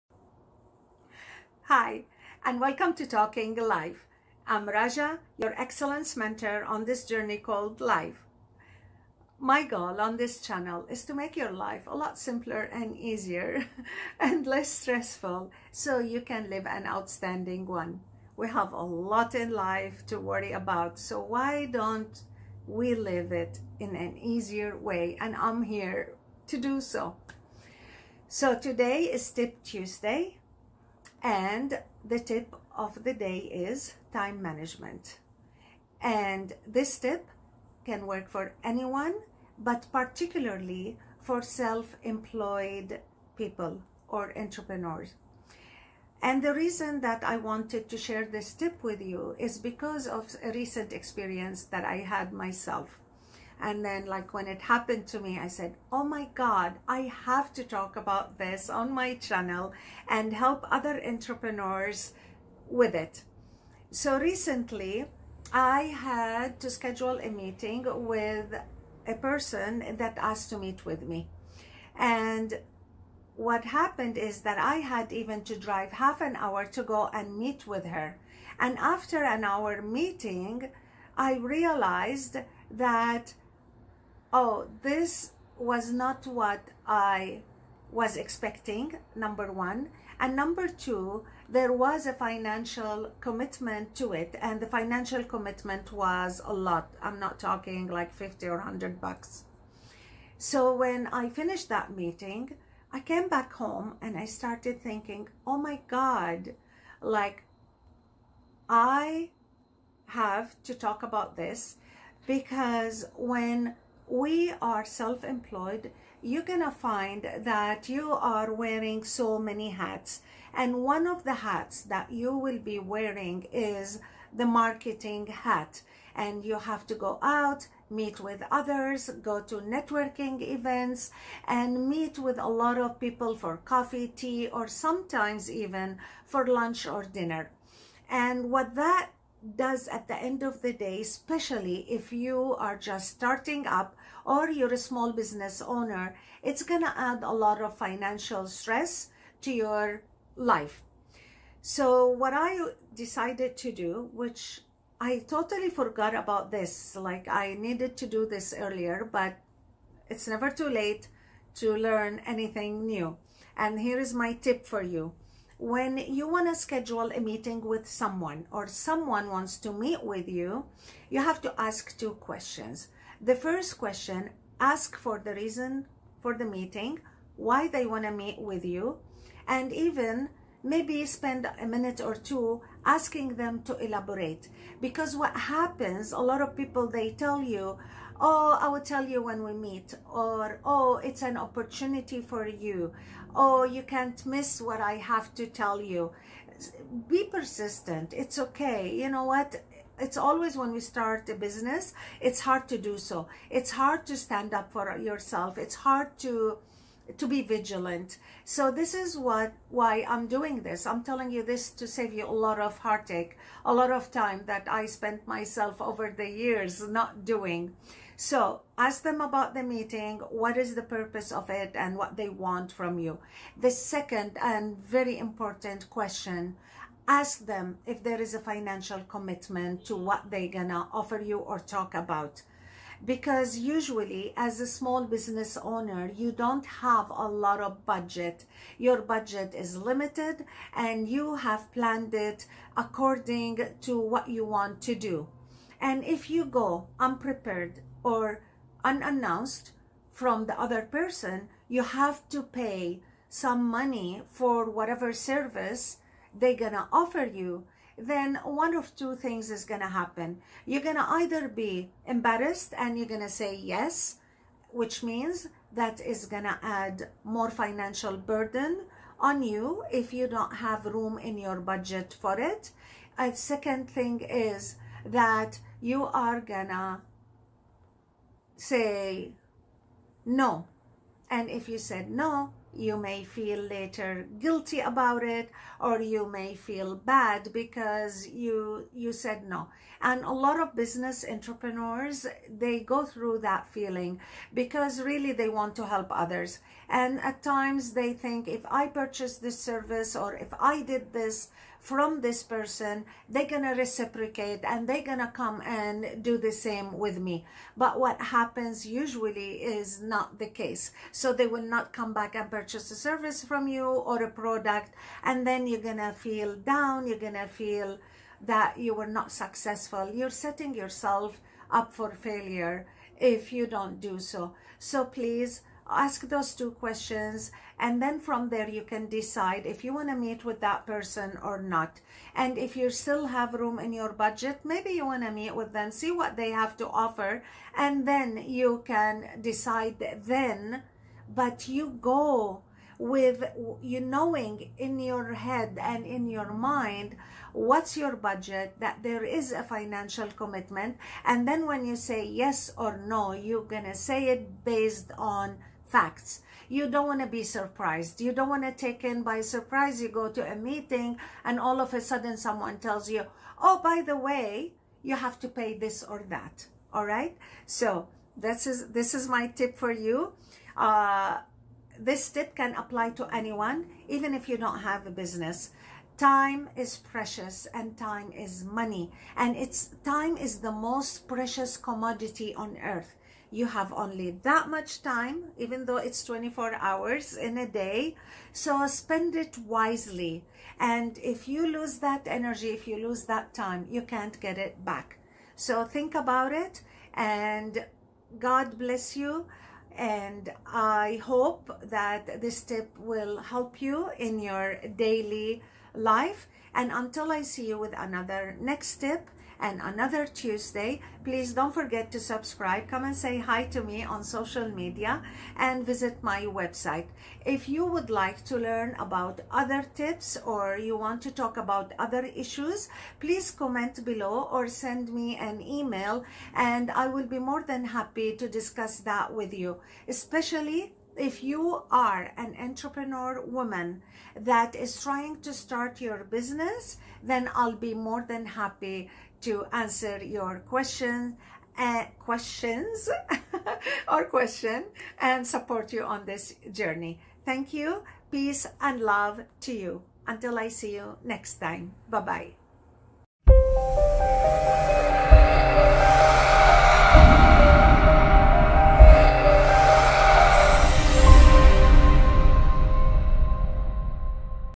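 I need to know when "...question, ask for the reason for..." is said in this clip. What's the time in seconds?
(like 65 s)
173 s.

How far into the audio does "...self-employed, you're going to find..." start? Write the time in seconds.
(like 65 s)
114 s.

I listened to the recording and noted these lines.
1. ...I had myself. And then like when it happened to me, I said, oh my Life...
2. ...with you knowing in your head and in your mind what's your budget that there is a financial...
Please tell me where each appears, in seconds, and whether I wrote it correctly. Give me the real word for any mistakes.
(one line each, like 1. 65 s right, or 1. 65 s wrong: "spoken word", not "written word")
1. 51 s wrong: "God", not "Life"
2. 342 s right.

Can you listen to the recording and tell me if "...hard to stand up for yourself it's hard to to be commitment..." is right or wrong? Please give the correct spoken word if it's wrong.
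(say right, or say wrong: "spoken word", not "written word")
wrong: "vigilant", not "commitment".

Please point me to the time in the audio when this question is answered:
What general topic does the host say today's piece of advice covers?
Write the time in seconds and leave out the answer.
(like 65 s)
34 s.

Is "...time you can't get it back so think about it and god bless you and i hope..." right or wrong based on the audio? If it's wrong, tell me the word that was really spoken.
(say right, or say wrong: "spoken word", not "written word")
right.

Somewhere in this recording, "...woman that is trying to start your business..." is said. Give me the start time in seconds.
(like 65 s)
433 s.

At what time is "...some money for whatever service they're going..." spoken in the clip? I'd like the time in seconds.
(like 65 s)
253 s.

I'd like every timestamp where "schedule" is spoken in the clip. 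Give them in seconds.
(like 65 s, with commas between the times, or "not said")
66 s, 166 s.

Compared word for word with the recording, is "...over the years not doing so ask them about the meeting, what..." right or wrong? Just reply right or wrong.
right.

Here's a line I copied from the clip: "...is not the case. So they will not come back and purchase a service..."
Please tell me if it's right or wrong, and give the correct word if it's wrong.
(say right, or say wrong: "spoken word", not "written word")
right.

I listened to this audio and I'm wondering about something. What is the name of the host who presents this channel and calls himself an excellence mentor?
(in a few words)
Raja.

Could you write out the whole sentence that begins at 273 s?
A second thing is that you are gonna say no.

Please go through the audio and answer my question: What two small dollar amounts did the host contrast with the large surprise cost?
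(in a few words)
50 or 100 bucks.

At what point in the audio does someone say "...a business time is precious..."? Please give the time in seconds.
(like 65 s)
375 s.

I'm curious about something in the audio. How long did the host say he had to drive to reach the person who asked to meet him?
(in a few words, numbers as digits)
Half an hour.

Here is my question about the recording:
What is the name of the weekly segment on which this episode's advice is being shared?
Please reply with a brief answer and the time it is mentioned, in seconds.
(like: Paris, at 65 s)
Tip Tuesday, at 29 s.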